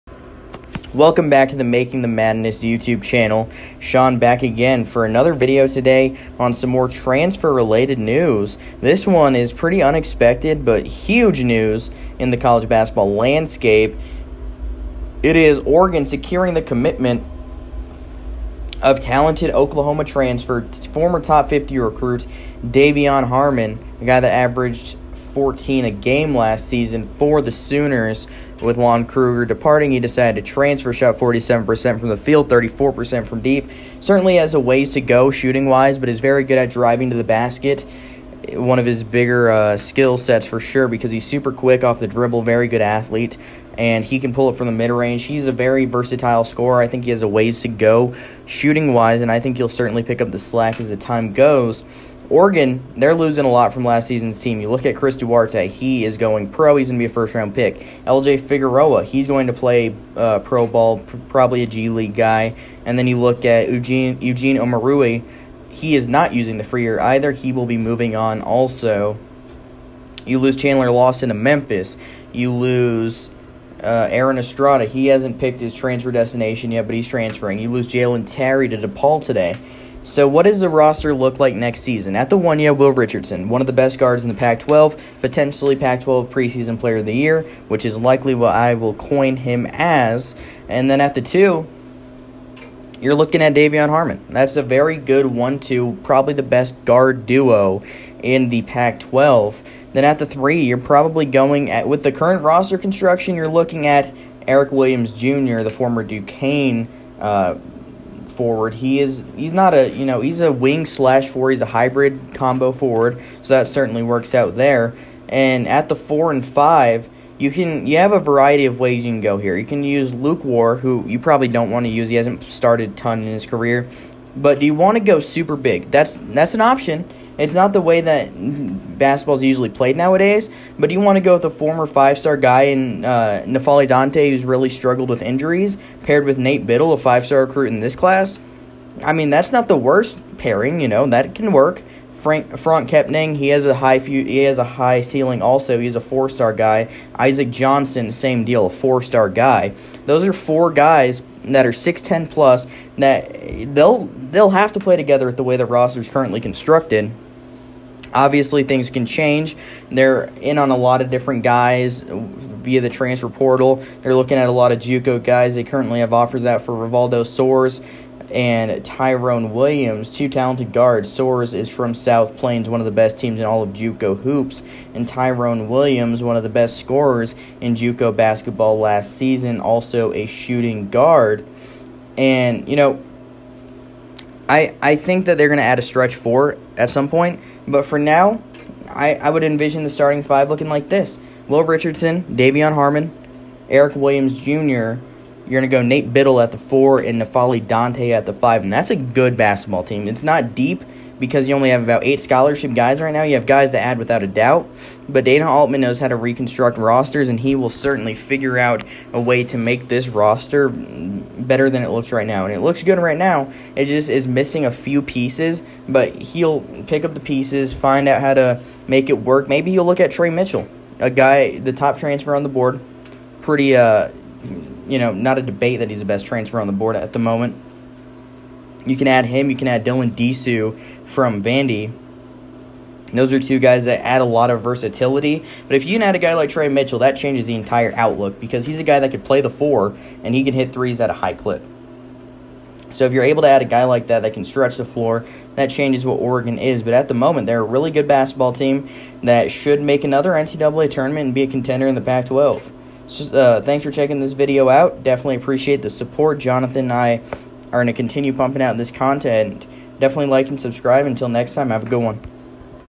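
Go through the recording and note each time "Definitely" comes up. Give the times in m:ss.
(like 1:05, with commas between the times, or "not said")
4:15, 4:19.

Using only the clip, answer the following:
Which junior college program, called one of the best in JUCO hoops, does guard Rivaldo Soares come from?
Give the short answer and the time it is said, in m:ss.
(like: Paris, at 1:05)
South Plains, at 2:51.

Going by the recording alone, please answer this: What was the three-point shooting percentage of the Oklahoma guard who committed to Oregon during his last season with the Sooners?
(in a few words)
34%.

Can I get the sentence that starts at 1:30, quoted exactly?
And then at the two, you're looking at Davion Harmon.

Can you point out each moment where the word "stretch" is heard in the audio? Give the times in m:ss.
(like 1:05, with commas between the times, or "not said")
3:05, 4:04.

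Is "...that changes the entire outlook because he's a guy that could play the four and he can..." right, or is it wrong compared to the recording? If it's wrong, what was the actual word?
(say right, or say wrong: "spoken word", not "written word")
right.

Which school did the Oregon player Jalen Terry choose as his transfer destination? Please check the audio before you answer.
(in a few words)
DePaul.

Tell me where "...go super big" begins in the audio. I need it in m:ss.
2:05.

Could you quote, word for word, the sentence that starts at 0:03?
Sean back again for another video today on some more transfer related news.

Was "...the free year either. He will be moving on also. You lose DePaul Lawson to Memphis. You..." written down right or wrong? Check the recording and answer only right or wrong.
wrong.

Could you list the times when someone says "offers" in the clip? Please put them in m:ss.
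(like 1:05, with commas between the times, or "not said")
2:46.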